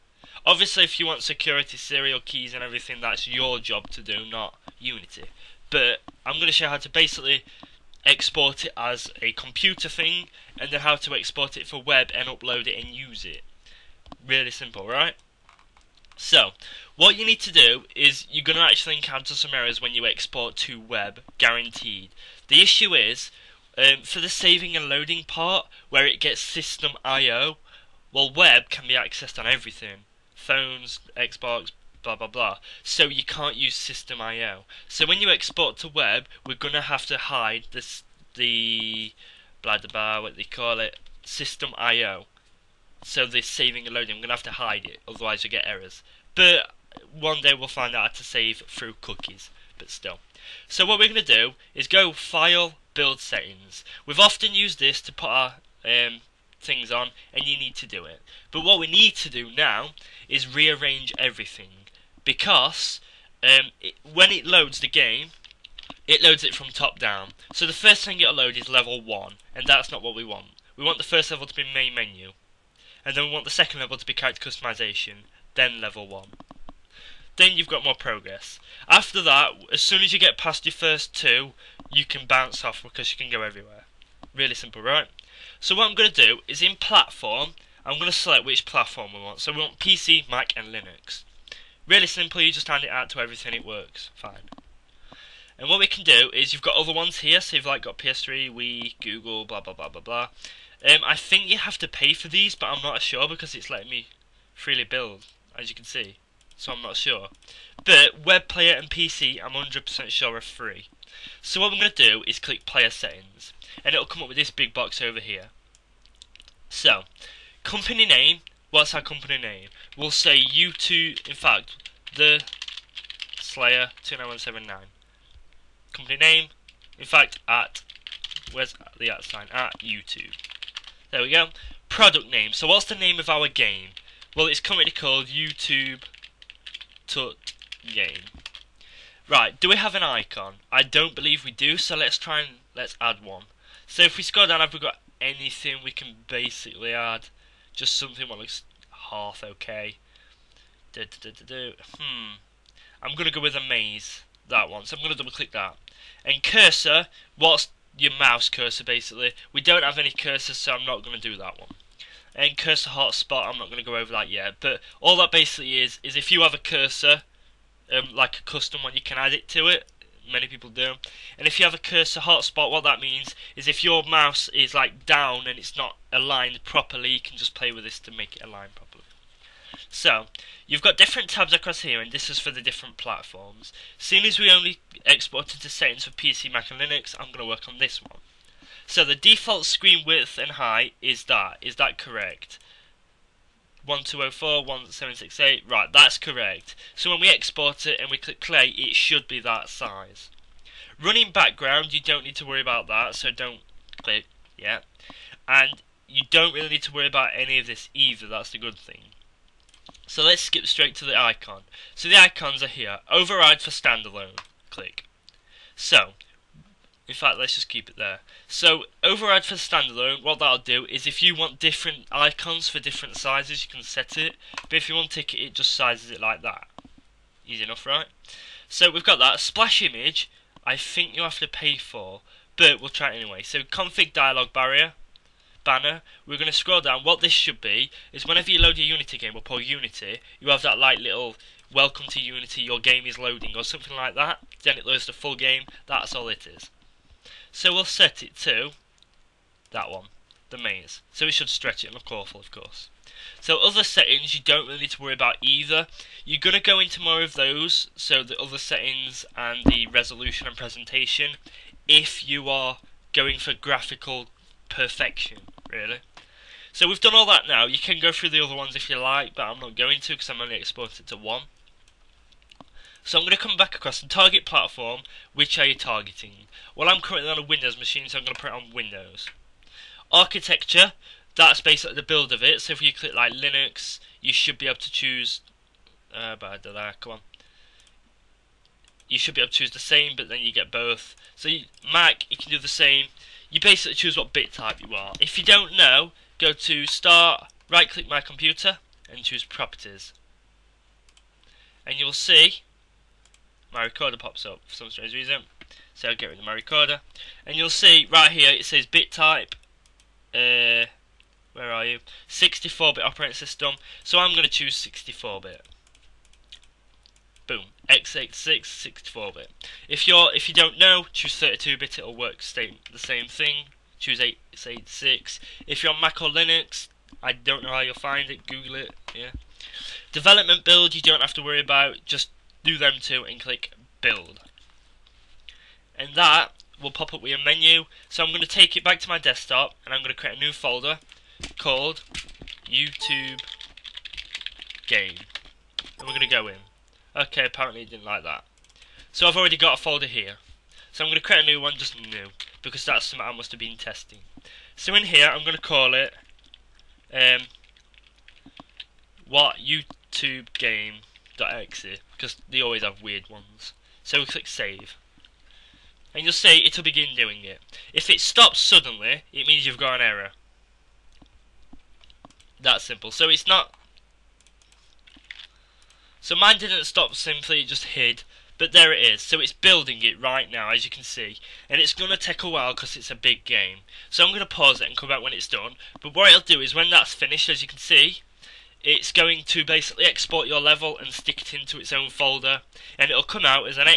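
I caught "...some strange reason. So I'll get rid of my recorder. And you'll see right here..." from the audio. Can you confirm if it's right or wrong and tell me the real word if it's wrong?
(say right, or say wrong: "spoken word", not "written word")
right.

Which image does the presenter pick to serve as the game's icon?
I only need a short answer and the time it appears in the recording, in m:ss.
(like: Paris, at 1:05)
A maze, at 2:33.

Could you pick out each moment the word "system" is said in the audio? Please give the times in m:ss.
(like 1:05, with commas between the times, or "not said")
0:26, 0:33, 0:41, 5:13.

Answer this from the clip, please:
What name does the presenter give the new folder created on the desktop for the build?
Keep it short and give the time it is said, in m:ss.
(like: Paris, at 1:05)
YouTube game, at 5:42.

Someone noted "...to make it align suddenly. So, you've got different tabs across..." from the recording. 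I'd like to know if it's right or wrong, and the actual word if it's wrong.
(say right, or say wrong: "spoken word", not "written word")
wrong: "properly", not "suddenly".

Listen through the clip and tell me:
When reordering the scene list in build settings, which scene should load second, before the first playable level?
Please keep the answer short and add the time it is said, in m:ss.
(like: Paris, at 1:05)
Character customization, at 1:14.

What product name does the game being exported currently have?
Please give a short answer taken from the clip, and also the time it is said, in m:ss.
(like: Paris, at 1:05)
YouTube Tut Game, at 2:15.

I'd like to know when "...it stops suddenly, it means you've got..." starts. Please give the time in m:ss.
6:08.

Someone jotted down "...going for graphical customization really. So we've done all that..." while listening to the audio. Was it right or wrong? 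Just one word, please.
wrong.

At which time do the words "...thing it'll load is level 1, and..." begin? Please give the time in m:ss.
1:08.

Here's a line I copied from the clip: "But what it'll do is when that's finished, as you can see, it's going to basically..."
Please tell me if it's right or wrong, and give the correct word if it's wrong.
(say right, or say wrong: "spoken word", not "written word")
right.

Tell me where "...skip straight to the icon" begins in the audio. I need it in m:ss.
3:30.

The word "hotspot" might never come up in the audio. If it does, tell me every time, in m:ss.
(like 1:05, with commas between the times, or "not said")
2:42, 2:52.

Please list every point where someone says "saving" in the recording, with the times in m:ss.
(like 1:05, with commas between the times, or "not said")
0:24, 0:43.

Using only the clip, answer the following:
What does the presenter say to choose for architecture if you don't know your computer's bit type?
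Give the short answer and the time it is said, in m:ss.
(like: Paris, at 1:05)
32-bit, at 5:21.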